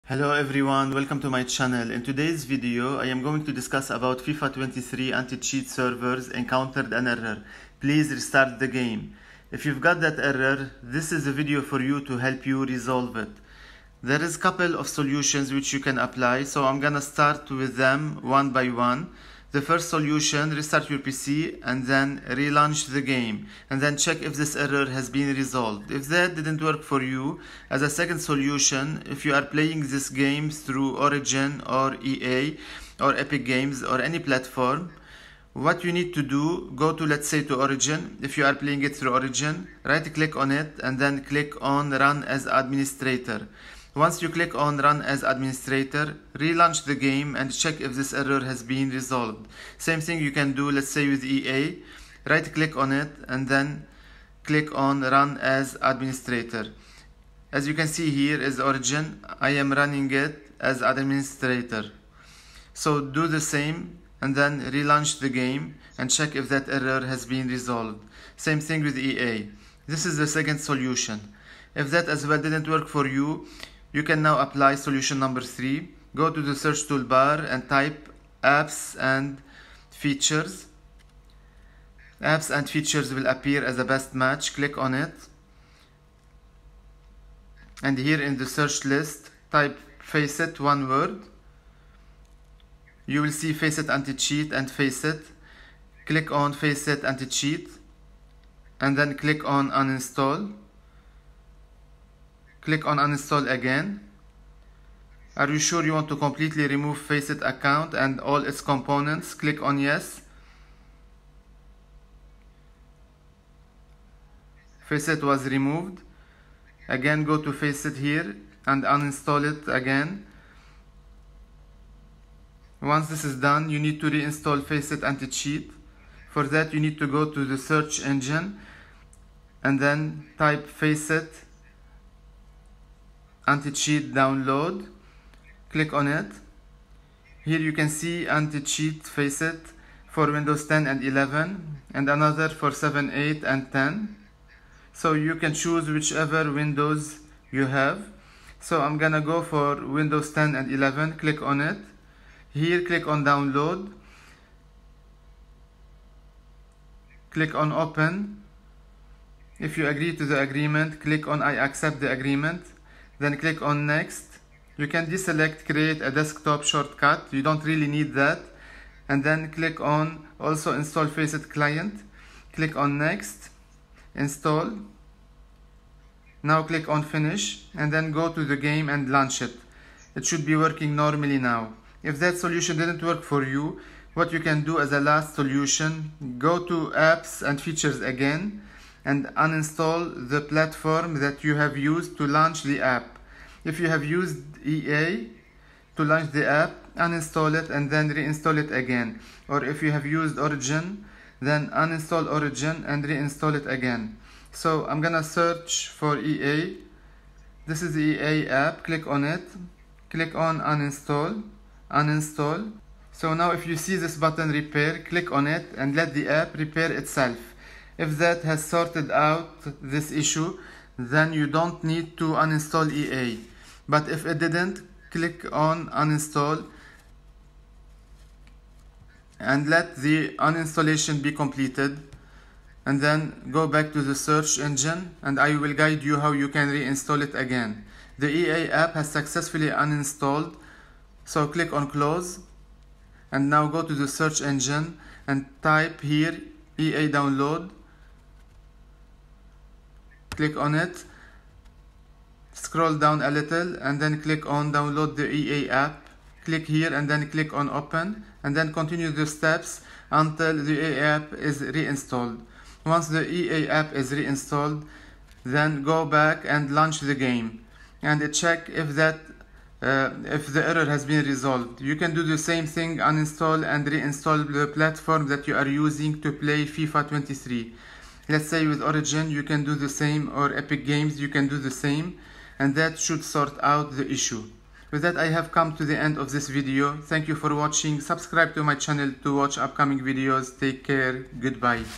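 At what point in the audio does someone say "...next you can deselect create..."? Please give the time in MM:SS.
02:43.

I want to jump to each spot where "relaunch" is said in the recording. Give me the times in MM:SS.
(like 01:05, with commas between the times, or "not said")
00:22, 00:46, 01:04.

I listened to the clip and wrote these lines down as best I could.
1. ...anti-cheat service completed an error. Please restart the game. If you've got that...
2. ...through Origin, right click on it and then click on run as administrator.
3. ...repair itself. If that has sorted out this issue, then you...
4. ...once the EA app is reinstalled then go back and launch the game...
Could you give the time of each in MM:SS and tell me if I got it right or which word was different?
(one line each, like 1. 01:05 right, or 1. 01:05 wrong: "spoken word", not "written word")
1. 00:05 wrong: "encountered", not "completed"
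2. 00:38 right
3. 03:36 right
4. 04:22 right.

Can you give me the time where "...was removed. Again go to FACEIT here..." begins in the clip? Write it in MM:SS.
01:55.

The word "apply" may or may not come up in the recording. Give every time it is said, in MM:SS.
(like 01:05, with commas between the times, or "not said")
00:15, 01:14.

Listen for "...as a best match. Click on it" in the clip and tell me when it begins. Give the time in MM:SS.
01:23.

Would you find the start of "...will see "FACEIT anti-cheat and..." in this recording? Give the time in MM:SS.
01:33.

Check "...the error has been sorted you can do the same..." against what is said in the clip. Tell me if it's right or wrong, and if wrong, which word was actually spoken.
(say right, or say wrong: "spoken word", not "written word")
wrong: "resolved", not "sorted".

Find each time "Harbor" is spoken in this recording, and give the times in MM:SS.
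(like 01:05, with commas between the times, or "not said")
not said.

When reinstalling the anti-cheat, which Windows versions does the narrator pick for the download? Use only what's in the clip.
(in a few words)
Windows 10 and 11.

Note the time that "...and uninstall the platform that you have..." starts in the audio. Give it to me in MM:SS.
03:09.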